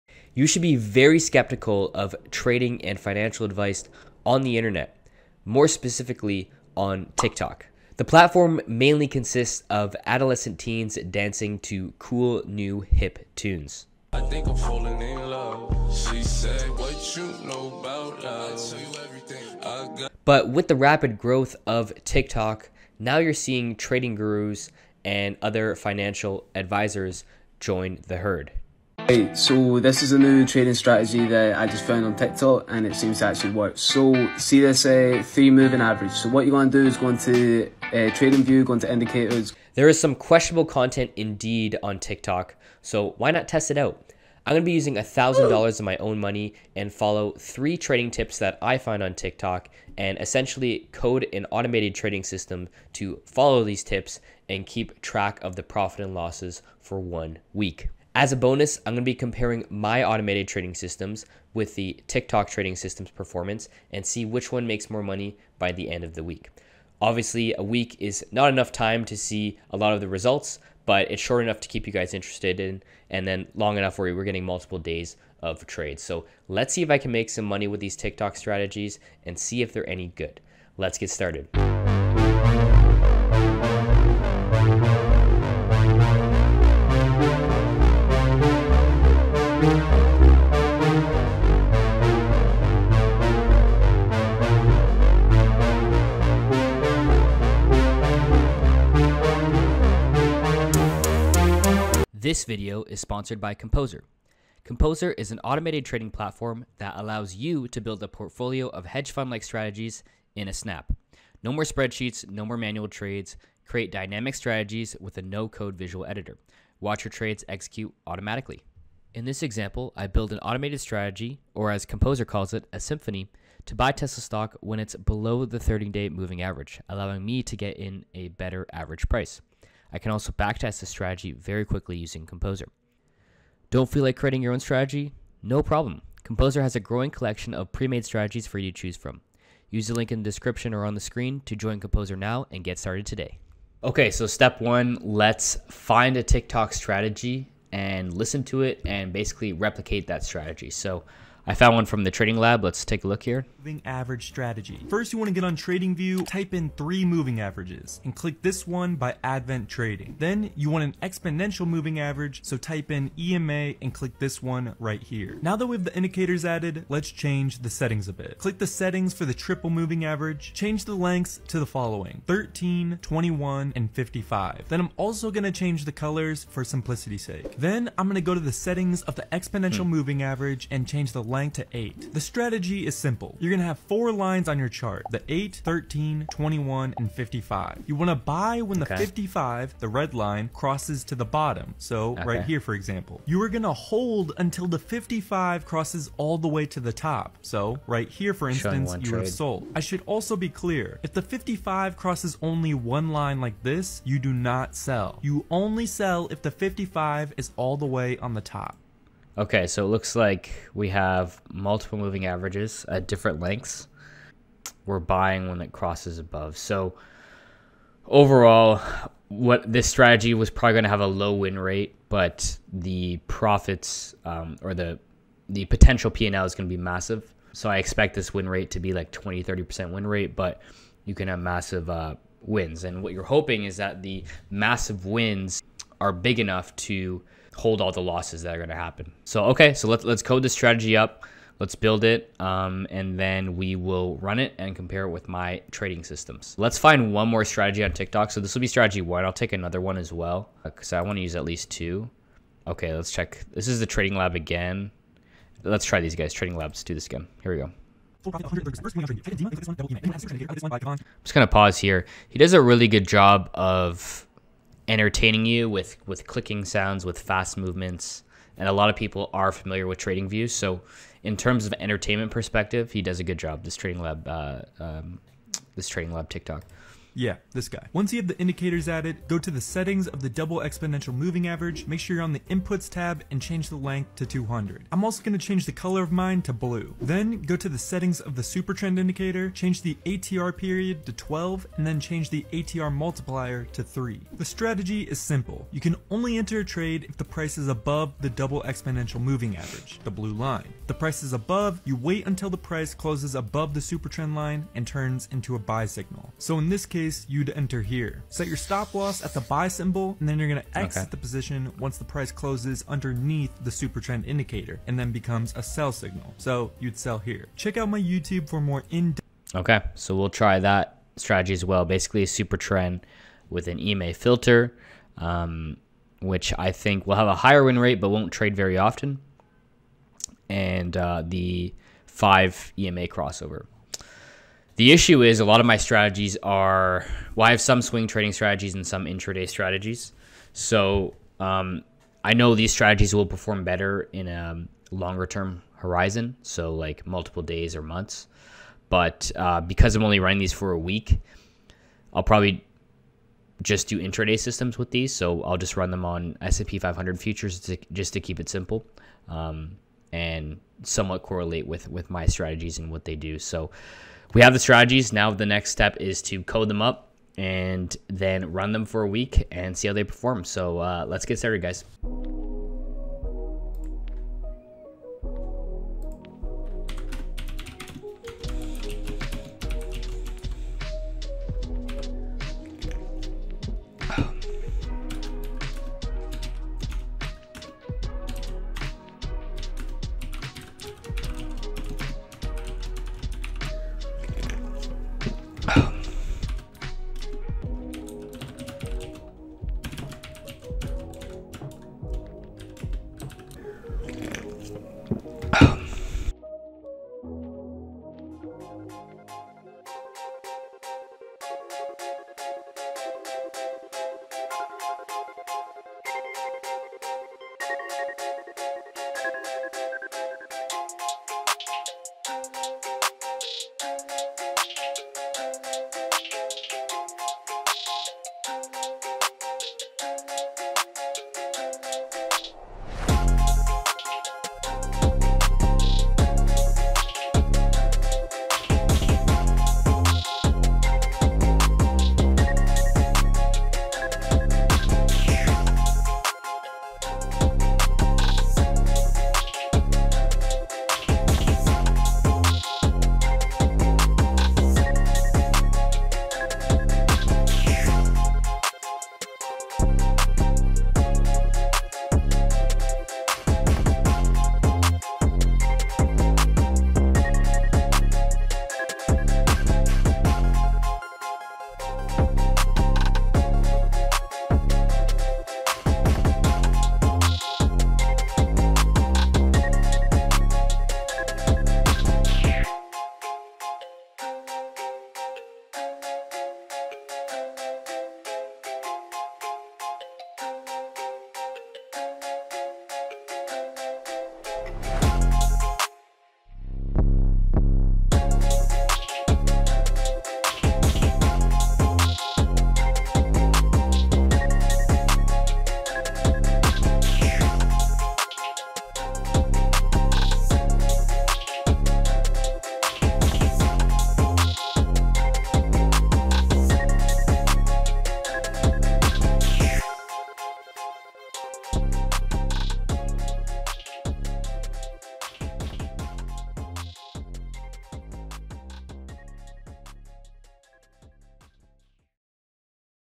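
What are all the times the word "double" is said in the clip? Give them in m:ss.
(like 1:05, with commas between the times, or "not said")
4:40, 4:58.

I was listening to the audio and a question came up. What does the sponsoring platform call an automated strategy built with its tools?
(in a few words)
a symphony.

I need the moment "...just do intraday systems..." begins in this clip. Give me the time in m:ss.
5:53.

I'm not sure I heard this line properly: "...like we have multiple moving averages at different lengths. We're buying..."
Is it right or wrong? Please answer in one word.
right.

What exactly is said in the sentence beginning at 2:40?
Then you want an exponential moving average.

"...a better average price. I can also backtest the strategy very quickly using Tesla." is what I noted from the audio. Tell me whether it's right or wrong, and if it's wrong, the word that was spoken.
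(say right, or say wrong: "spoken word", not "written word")
wrong: "Composer", not "Tesla".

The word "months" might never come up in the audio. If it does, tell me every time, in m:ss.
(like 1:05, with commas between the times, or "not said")
5:47.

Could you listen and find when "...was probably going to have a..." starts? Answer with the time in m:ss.
3:40.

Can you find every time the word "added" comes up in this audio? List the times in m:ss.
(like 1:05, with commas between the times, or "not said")
2:46, 4:38.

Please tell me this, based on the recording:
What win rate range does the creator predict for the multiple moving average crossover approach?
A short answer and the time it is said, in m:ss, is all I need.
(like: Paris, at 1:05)
20 to 30%, at 3:49.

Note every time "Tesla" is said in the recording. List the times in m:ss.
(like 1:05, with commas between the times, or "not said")
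2:03.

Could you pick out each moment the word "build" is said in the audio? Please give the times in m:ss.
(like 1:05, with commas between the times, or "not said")
1:47, 2:00, 4:01.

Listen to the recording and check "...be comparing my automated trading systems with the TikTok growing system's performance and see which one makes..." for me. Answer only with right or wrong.
wrong.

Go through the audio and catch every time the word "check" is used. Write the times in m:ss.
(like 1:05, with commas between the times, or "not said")
4:13, 5:17.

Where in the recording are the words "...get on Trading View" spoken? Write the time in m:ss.
2:35.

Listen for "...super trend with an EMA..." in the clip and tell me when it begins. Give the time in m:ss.
5:22.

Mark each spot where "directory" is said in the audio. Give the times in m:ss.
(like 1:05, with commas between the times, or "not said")
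not said.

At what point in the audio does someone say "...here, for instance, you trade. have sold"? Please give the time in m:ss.
3:18.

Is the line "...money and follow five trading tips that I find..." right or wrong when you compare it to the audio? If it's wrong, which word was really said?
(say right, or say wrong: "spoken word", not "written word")
wrong: "three", not "five".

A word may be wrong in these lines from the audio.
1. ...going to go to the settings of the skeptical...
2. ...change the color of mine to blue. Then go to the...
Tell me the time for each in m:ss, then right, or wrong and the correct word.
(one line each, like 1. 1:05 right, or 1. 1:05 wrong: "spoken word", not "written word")
1. 2:58 wrong: "exponential", not "skeptical"
2. 4:45 right.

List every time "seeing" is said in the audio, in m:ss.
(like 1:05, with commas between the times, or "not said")
0:23.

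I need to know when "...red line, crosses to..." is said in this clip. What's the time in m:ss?
3:09.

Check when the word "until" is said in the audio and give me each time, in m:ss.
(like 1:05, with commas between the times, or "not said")
3:14, 5:02.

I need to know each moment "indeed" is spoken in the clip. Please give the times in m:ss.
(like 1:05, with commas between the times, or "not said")
0:41.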